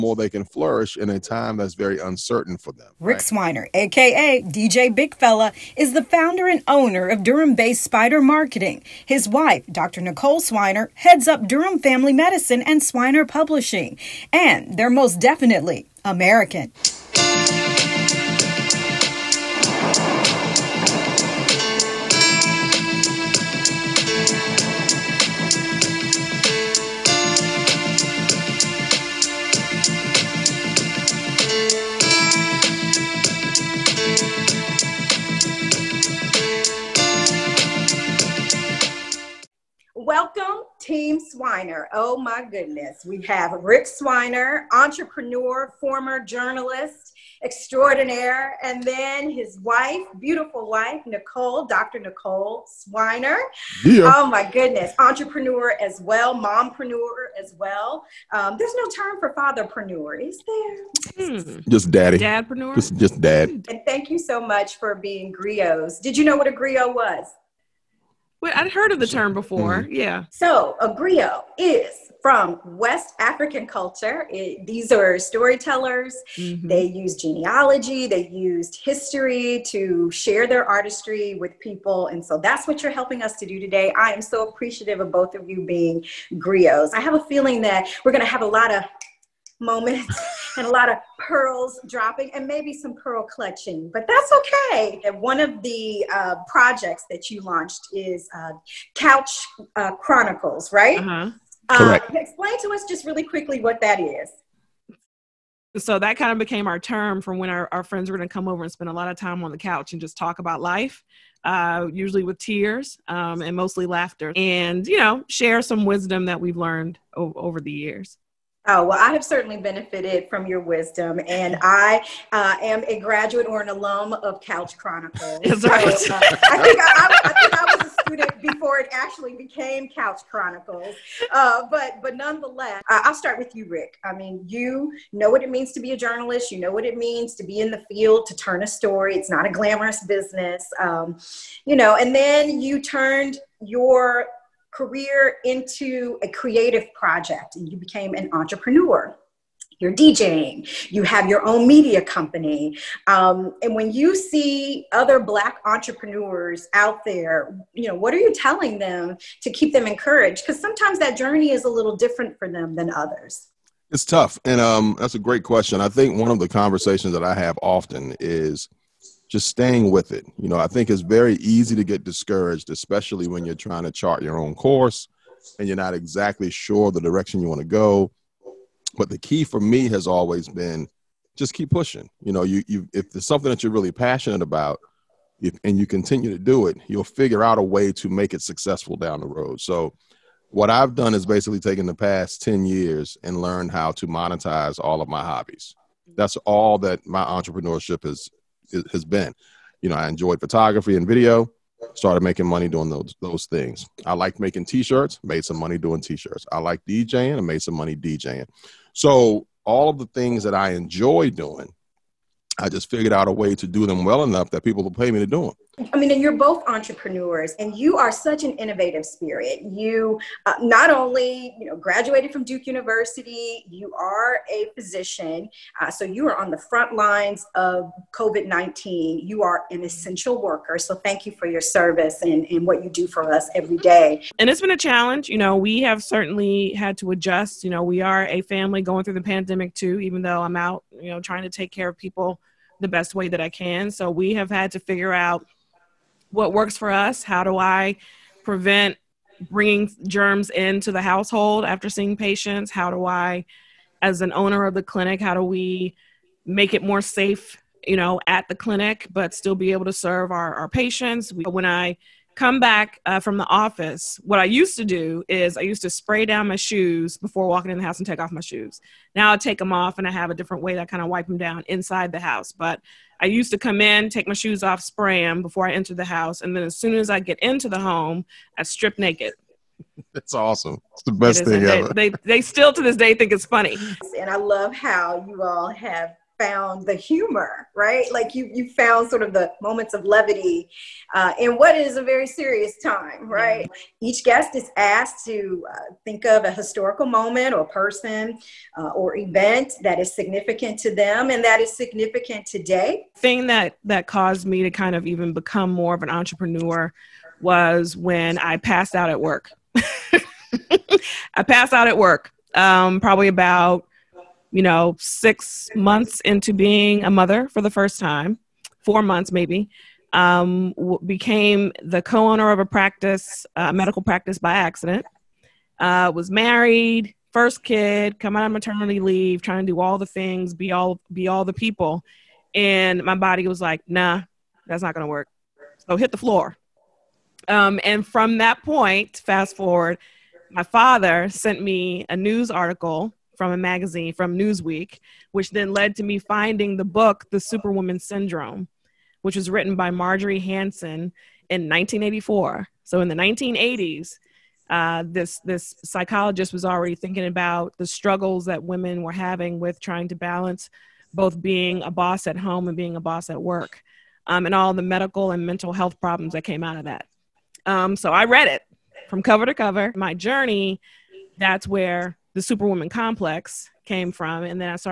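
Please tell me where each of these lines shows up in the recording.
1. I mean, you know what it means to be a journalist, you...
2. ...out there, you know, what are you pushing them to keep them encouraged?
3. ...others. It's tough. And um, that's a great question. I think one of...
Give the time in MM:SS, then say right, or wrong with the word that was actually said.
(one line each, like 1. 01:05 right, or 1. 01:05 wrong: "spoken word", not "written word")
1. 02:14 right
2. 02:36 wrong: "telling", not "pushing"
3. 02:42 right.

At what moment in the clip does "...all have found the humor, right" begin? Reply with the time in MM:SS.
04:45.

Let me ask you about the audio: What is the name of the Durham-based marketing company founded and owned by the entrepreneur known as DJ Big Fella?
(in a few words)
Spider Marketing.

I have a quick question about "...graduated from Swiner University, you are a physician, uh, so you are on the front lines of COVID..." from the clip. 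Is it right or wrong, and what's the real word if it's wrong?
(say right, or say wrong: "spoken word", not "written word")
wrong: "Duke", not "Swiner".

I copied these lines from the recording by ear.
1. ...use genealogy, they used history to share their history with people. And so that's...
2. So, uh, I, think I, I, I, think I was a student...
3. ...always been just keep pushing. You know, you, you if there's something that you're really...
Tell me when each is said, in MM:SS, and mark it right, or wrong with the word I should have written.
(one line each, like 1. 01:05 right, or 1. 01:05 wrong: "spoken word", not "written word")
1. 01:16 wrong: "artistry", not "history"
2. 02:05 right
3. 03:00 right.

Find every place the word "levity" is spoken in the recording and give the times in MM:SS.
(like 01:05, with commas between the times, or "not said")
04:50.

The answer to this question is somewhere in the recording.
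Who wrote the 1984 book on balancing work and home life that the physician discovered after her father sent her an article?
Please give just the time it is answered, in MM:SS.
05:49.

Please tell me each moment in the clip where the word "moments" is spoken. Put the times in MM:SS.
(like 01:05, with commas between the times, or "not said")
01:29, 04:49, 04:57.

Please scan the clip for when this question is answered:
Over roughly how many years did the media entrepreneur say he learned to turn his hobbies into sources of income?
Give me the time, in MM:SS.
03:12.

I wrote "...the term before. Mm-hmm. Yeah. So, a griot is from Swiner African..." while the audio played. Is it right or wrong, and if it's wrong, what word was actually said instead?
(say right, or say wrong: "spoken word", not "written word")
wrong: "West", not "Swiner".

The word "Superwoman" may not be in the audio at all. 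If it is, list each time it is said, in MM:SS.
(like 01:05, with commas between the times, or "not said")
05:47, 06:12.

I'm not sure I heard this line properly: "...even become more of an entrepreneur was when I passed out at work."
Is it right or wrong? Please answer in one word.
right.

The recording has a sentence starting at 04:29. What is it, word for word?
Now I take them off and I have a different way that I kind of wipe them down inside the house.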